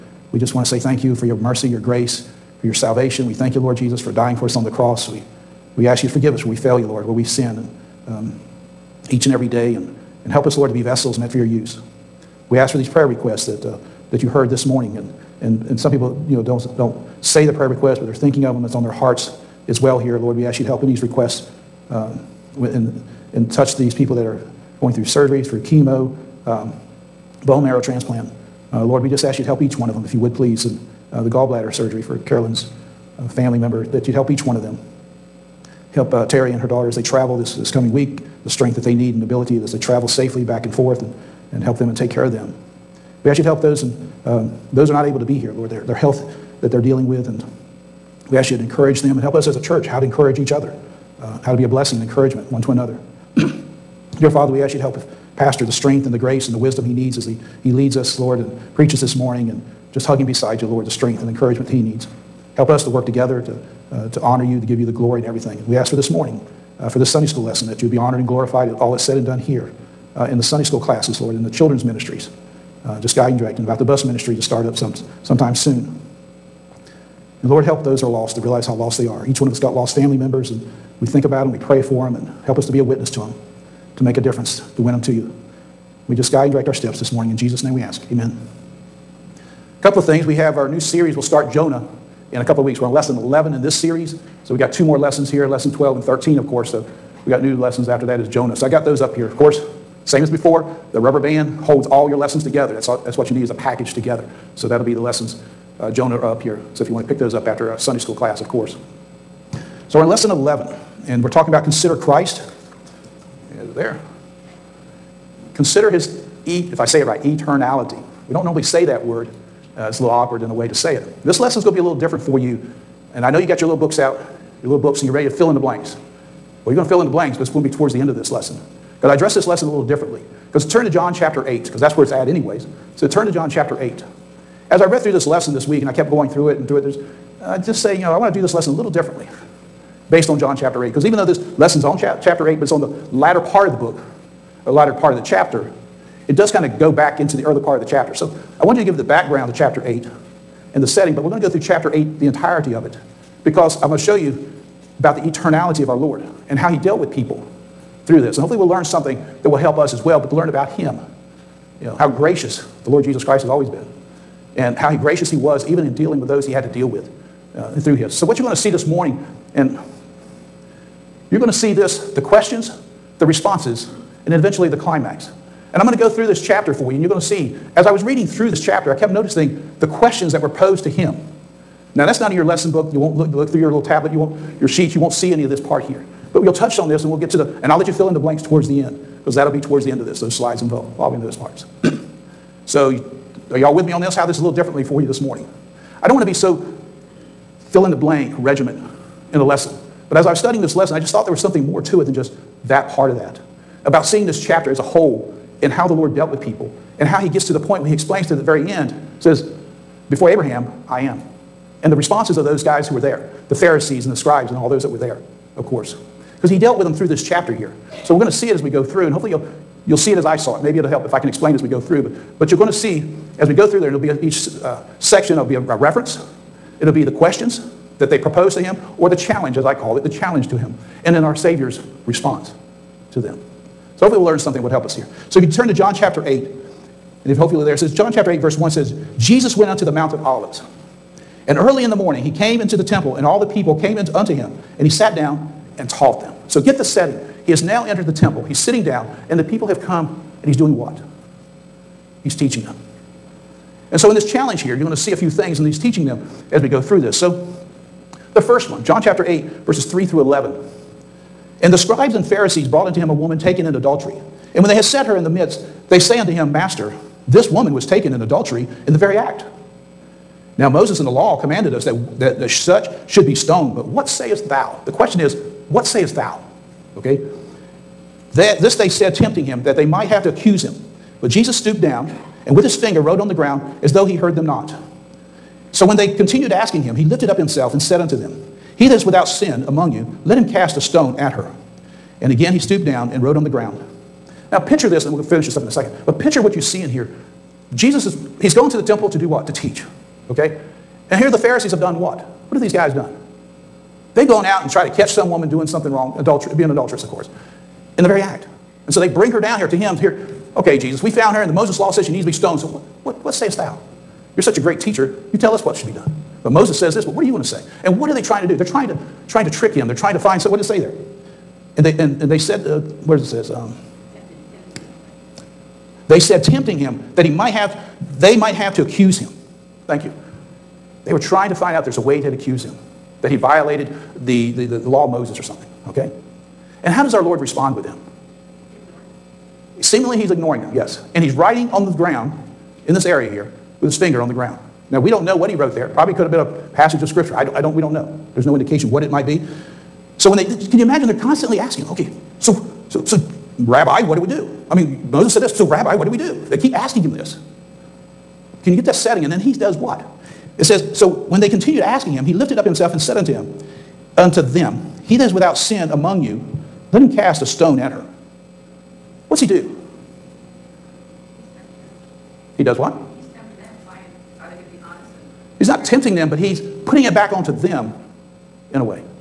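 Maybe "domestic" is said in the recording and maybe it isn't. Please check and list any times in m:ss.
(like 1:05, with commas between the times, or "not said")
not said.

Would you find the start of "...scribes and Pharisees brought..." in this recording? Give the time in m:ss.
4:21.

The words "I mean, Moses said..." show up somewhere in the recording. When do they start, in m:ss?
5:54.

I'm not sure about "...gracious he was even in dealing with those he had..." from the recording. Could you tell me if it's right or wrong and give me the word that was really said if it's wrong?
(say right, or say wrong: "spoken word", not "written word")
right.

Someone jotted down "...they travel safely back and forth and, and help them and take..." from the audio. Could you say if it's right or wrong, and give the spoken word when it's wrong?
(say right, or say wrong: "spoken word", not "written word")
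right.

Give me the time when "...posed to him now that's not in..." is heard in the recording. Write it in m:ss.
3:00.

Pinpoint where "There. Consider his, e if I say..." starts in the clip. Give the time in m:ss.
1:53.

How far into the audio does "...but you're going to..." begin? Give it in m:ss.
3:42.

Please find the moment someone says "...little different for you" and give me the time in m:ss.
2:01.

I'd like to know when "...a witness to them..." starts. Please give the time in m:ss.
1:22.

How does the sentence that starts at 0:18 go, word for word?
It's on their hearts as well here, Lord.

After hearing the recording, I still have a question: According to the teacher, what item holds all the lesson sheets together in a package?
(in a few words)
rubber band.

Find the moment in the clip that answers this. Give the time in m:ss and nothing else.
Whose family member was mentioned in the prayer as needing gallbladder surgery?
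0:32.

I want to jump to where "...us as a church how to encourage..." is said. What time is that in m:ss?
0:49.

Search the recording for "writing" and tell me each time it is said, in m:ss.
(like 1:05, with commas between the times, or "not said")
5:41.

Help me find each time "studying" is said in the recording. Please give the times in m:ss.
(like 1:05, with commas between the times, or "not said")
3:20.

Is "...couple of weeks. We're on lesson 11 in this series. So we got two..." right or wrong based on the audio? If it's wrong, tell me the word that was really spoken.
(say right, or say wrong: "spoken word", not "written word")
right.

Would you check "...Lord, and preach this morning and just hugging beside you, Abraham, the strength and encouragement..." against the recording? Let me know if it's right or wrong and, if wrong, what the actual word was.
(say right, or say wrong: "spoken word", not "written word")
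wrong: "Lord", not "Abraham".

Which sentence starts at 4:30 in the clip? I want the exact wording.
Now, Moses in the law commanded us that, that, that such should be stoned, but what sayest thou?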